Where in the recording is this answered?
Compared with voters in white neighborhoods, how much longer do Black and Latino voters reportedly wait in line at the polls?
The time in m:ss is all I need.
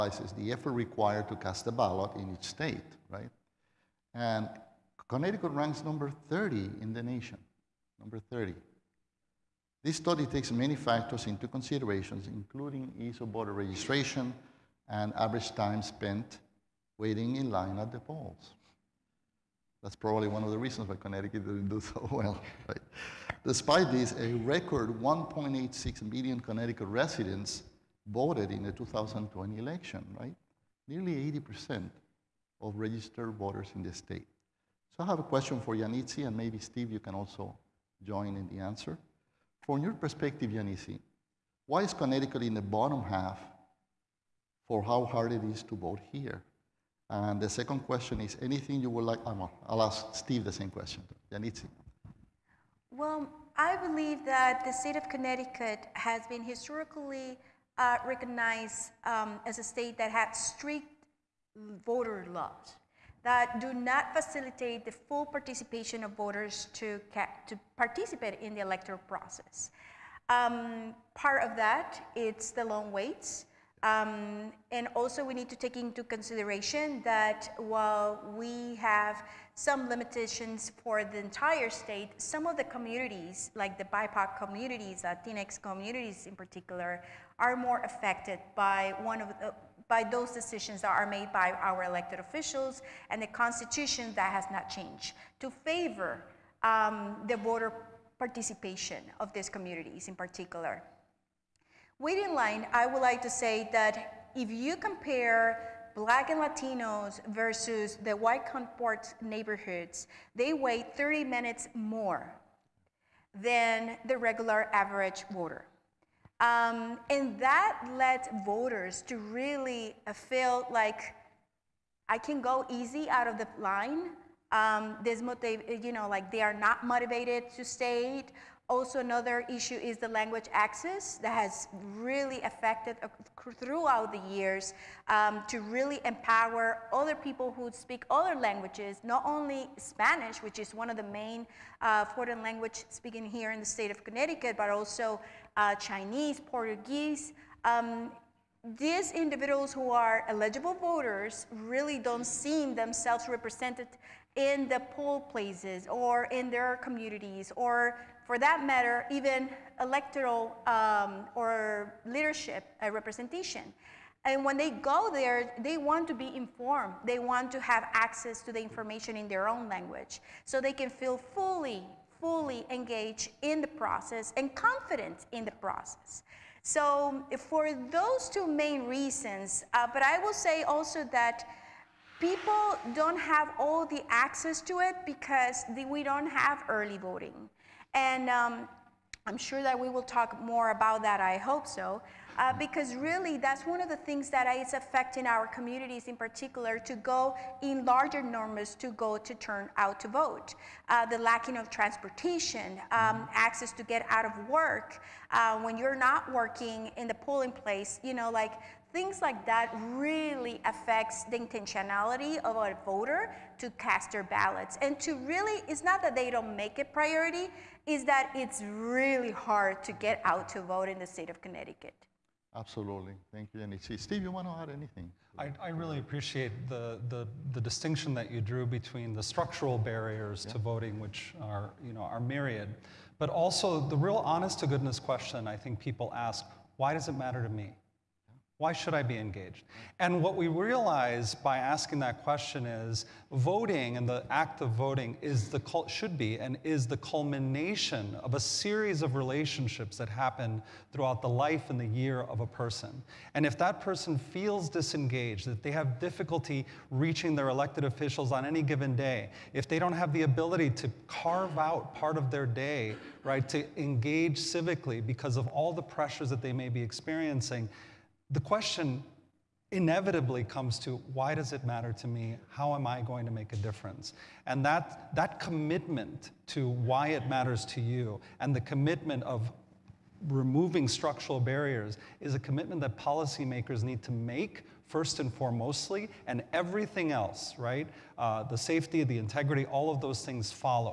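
1:50.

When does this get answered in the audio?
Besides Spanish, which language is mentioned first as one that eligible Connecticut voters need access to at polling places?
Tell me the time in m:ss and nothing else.
2:25.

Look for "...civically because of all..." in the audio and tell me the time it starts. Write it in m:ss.
4:24.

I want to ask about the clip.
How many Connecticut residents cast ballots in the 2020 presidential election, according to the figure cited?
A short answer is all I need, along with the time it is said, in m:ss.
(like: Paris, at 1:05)
1.86 million, at 0:25.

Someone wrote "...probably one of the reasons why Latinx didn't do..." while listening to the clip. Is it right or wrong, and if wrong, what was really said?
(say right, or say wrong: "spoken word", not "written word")
wrong: "Connecticut", not "Latinx".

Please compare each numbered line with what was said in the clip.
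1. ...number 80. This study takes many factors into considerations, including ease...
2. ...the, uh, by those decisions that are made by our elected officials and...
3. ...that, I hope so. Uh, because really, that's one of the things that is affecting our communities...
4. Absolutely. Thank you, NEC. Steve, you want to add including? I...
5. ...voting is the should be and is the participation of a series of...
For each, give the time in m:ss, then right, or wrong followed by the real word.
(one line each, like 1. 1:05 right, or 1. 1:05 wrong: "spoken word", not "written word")
1. 0:07 wrong: "30", not "80"
2. 1:29 right
3. 3:11 right
4. 3:42 wrong: "anything", not "including"
5. 4:04 wrong: "culmination", not "participation".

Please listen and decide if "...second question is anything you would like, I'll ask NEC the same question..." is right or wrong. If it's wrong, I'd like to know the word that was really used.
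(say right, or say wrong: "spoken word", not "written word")
wrong: "Steve", not "NEC".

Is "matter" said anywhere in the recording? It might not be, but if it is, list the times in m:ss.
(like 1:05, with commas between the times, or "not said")
2:38, 3:57, 4:31, 4:37.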